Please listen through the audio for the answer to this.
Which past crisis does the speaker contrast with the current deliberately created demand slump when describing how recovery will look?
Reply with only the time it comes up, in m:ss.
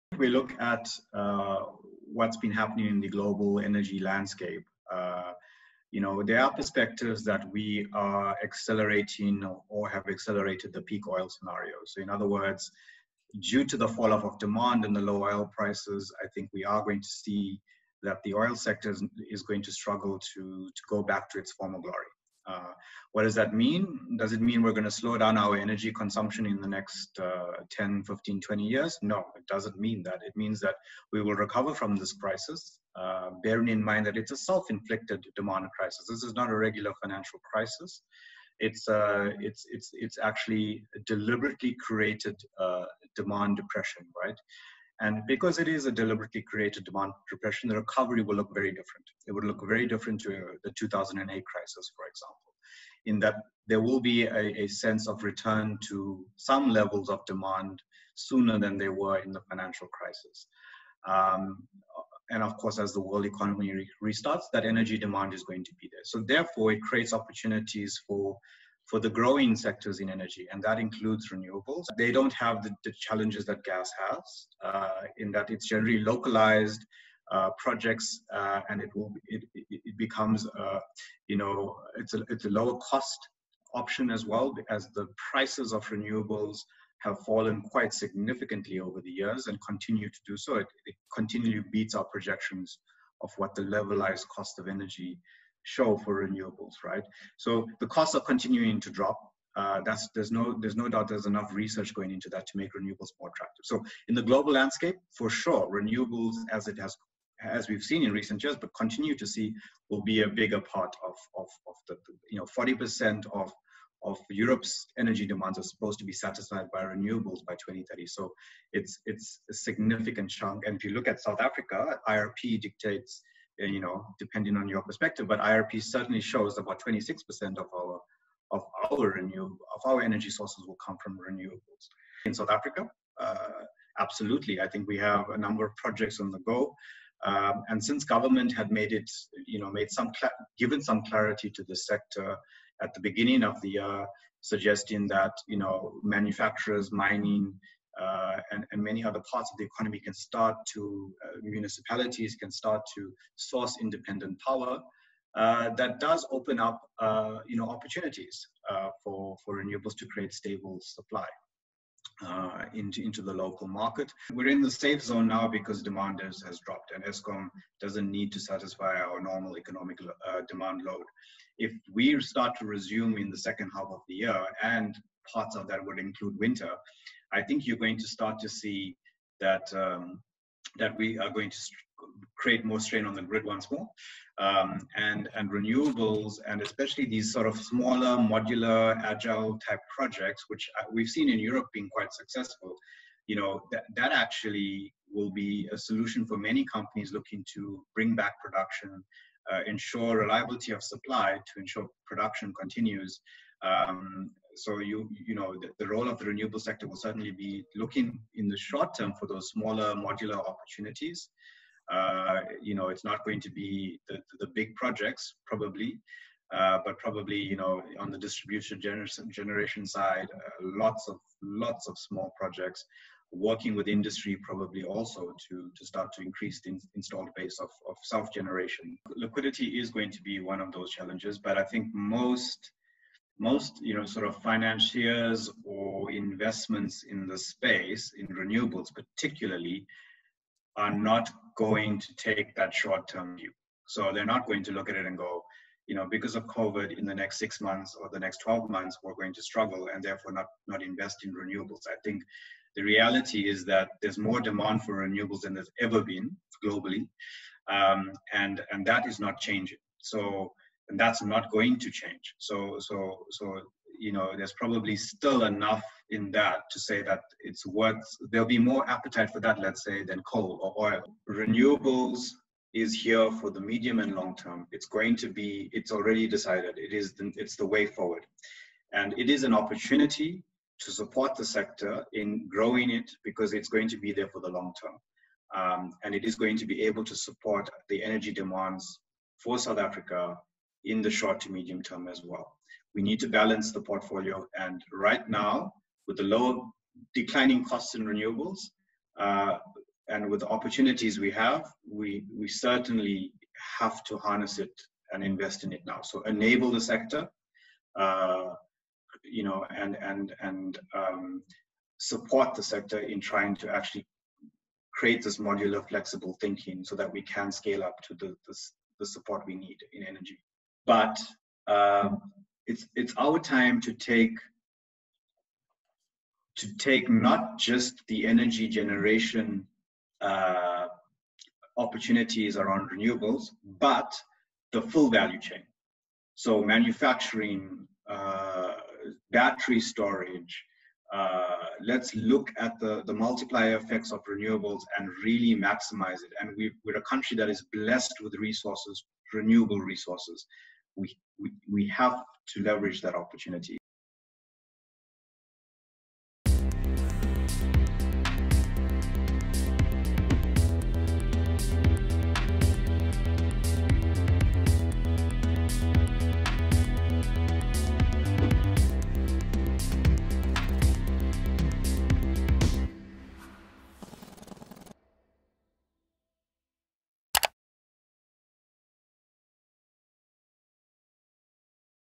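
0:50.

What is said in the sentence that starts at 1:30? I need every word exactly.
It, it, continually beats our projections of what the levelized cost of energy show for renewables, right?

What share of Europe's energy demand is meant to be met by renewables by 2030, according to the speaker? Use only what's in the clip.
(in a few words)
40%.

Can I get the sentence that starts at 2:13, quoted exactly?
Uh, absolutely, I think we have a number of projects on the go.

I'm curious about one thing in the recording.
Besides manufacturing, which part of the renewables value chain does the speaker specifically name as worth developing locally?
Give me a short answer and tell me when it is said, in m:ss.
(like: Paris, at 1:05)
battery storage, at 5:39.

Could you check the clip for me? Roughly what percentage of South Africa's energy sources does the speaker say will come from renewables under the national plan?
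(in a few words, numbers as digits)
26%.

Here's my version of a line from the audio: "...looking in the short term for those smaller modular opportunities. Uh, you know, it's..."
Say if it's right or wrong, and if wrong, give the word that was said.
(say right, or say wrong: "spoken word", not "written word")
right.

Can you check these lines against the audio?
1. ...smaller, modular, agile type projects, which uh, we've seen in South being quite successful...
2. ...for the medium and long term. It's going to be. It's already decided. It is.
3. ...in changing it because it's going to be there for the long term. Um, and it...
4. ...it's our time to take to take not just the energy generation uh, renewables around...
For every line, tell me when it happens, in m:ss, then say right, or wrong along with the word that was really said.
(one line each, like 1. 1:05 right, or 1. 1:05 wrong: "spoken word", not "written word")
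1. 3:07 wrong: "Europe", not "South"
2. 4:33 right
3. 4:42 wrong: "growing", not "changing"
4. 5:22 wrong: "opportunities", not "renewables".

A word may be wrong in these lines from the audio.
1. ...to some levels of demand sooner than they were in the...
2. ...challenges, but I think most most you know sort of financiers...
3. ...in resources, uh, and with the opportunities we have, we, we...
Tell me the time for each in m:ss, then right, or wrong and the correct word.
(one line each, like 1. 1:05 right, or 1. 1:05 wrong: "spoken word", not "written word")
1. 0:55 right
2. 3:50 right
3. 4:57 wrong: "renewables", not "resources".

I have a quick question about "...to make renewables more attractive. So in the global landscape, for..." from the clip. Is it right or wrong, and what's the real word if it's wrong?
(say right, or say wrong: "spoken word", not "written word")
right.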